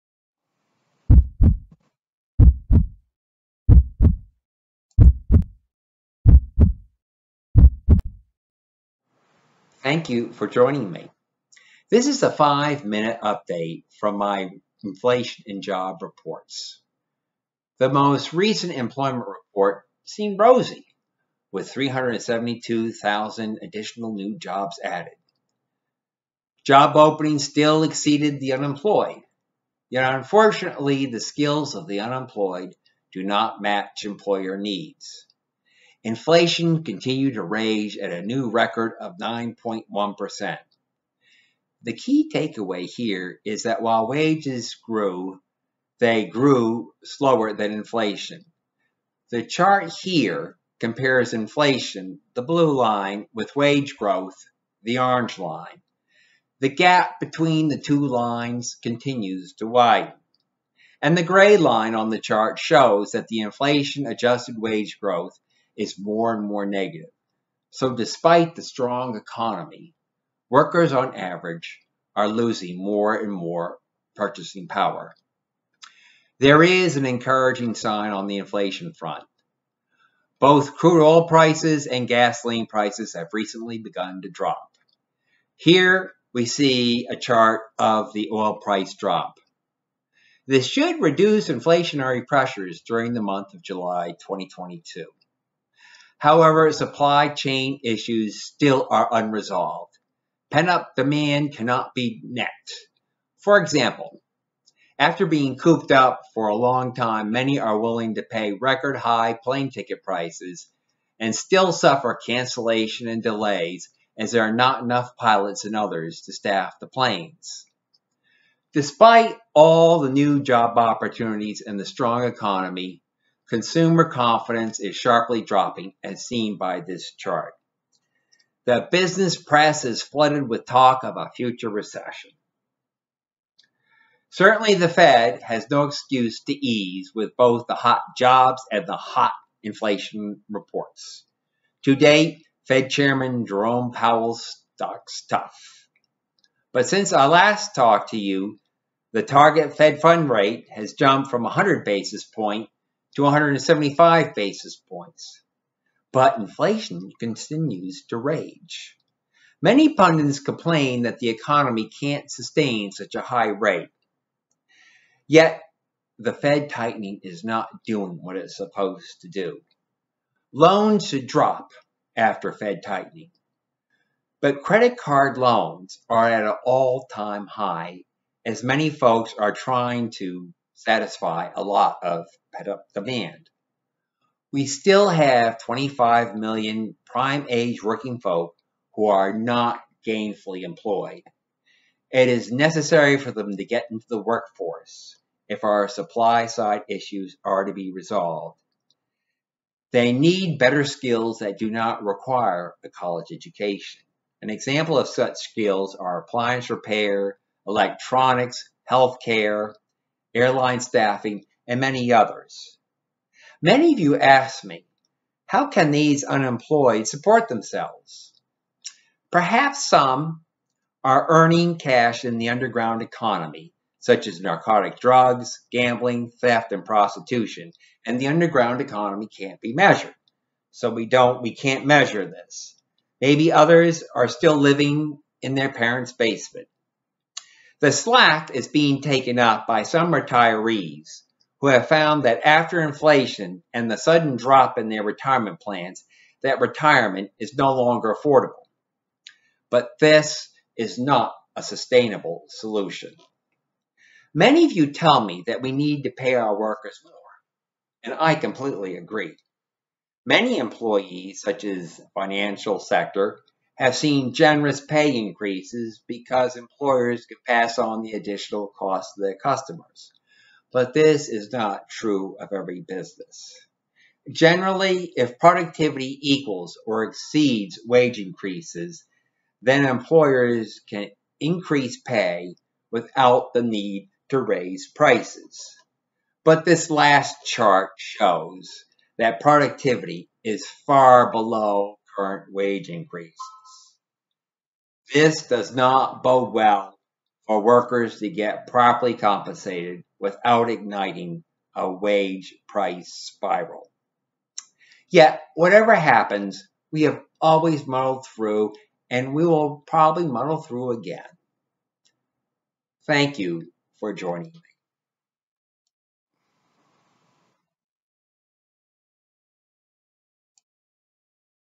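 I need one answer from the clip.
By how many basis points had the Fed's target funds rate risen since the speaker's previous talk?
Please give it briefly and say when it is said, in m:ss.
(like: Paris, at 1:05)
175 basis points, at 2:33.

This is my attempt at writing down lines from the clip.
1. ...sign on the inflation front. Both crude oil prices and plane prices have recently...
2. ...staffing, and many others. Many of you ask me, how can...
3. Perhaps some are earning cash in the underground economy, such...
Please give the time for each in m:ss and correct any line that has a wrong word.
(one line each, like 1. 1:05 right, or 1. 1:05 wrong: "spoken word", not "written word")
1. 1:17 wrong: "gasoline", not "plane"
2. 3:30 right
3. 3:39 right.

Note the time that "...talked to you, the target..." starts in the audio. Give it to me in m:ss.
2:27.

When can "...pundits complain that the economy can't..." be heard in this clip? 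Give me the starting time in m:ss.
2:39.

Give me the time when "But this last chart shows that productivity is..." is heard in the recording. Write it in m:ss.
4:46.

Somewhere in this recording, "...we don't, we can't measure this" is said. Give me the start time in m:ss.
3:50.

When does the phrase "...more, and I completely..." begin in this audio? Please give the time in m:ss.
4:17.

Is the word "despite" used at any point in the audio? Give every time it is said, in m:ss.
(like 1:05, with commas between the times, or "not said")
1:07, 1:58.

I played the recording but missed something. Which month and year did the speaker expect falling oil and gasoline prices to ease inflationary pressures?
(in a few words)
July 2022.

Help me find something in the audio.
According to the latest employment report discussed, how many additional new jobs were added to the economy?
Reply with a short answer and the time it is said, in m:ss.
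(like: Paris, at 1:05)
372,000, at 0:21.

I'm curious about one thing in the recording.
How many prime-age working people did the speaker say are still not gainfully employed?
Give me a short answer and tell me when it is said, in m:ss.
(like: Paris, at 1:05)
25 million, at 3:05.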